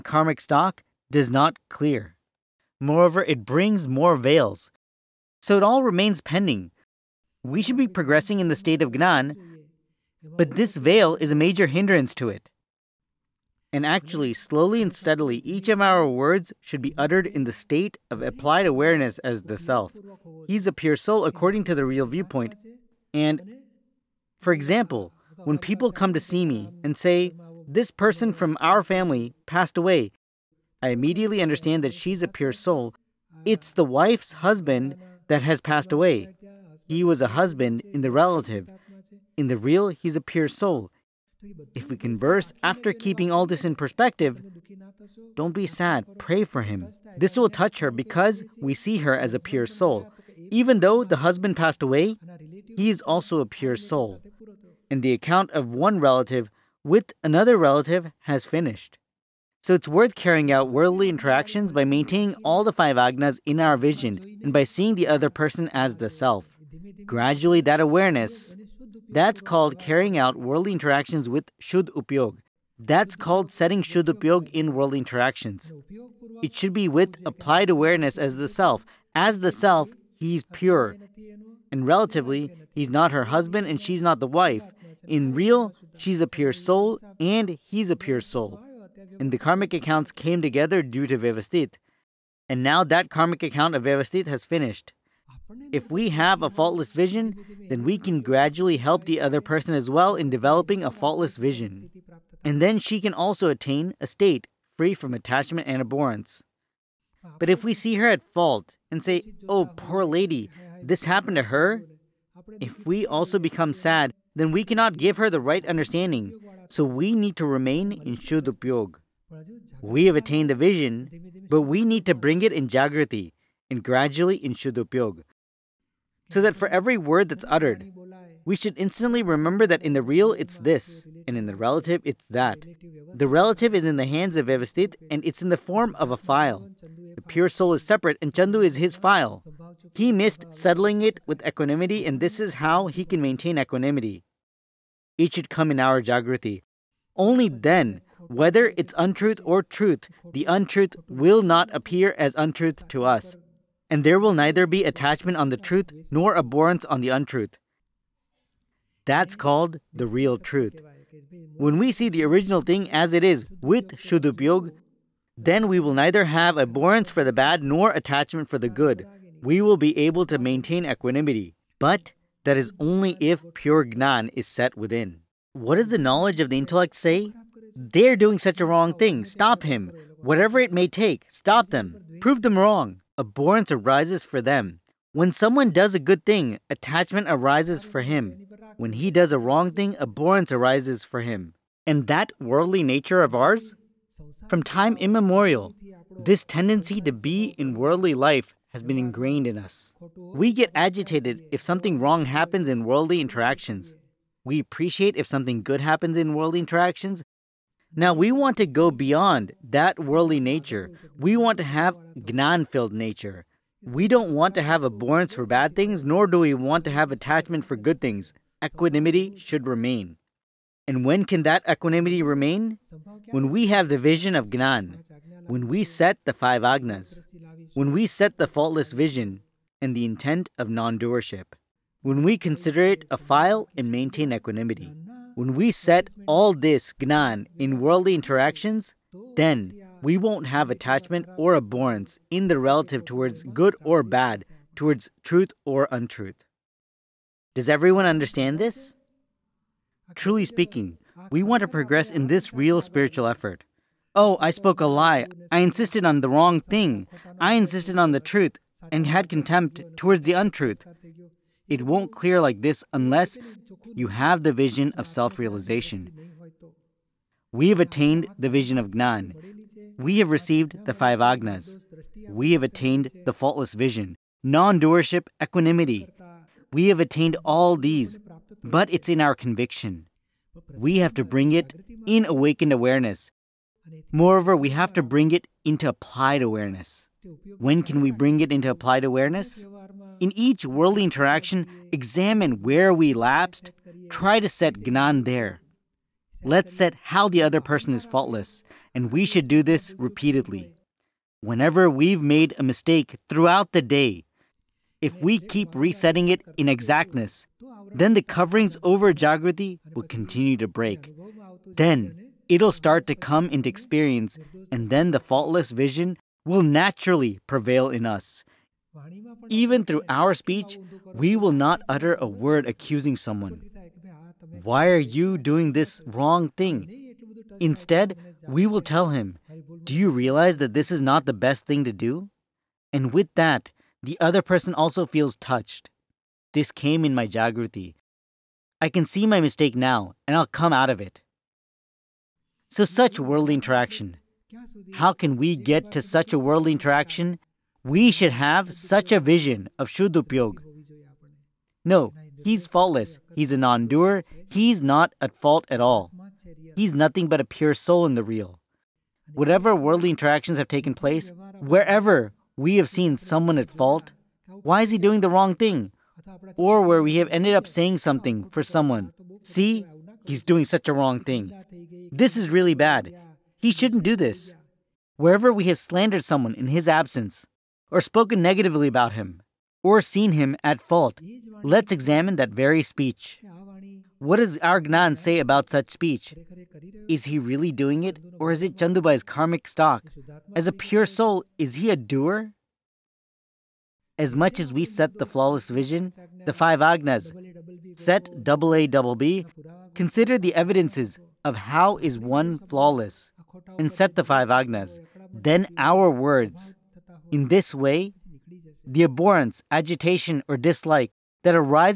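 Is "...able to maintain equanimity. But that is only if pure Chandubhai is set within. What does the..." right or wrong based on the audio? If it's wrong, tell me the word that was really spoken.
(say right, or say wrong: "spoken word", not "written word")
wrong: "Gnan", not "Chandubhai".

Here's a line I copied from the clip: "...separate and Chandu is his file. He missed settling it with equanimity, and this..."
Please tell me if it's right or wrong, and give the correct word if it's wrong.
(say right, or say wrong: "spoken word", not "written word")
right.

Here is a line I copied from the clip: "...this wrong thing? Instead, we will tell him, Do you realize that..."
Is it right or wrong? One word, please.
right.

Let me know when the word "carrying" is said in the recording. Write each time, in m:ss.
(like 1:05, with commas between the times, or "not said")
1:00, 1:09.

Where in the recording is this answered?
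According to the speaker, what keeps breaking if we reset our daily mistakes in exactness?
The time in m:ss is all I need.
5:08.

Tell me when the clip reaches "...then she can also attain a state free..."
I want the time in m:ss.
1:42.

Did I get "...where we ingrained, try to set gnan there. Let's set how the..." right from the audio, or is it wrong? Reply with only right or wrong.
wrong.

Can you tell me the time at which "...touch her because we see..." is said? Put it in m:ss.
0:47.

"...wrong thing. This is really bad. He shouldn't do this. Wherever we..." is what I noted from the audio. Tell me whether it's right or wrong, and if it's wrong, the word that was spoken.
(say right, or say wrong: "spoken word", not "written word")
right.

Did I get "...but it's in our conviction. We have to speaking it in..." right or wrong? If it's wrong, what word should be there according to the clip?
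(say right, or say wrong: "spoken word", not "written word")
wrong: "bring", not "speaking".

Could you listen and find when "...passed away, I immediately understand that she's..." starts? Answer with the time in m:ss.
0:29.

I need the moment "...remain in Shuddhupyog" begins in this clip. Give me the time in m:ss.
1:57.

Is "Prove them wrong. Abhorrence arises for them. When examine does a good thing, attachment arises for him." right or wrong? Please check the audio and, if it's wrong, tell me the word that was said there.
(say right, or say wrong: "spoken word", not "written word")
wrong: "someone", not "examine".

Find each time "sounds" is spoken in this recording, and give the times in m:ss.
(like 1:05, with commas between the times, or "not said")
not said.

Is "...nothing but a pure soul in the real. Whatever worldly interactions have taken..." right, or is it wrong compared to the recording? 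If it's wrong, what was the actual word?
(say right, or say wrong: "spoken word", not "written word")
right.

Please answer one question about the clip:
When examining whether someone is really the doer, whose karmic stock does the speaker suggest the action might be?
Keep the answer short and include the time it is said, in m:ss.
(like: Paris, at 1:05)
Chandubhai's, at 6:28.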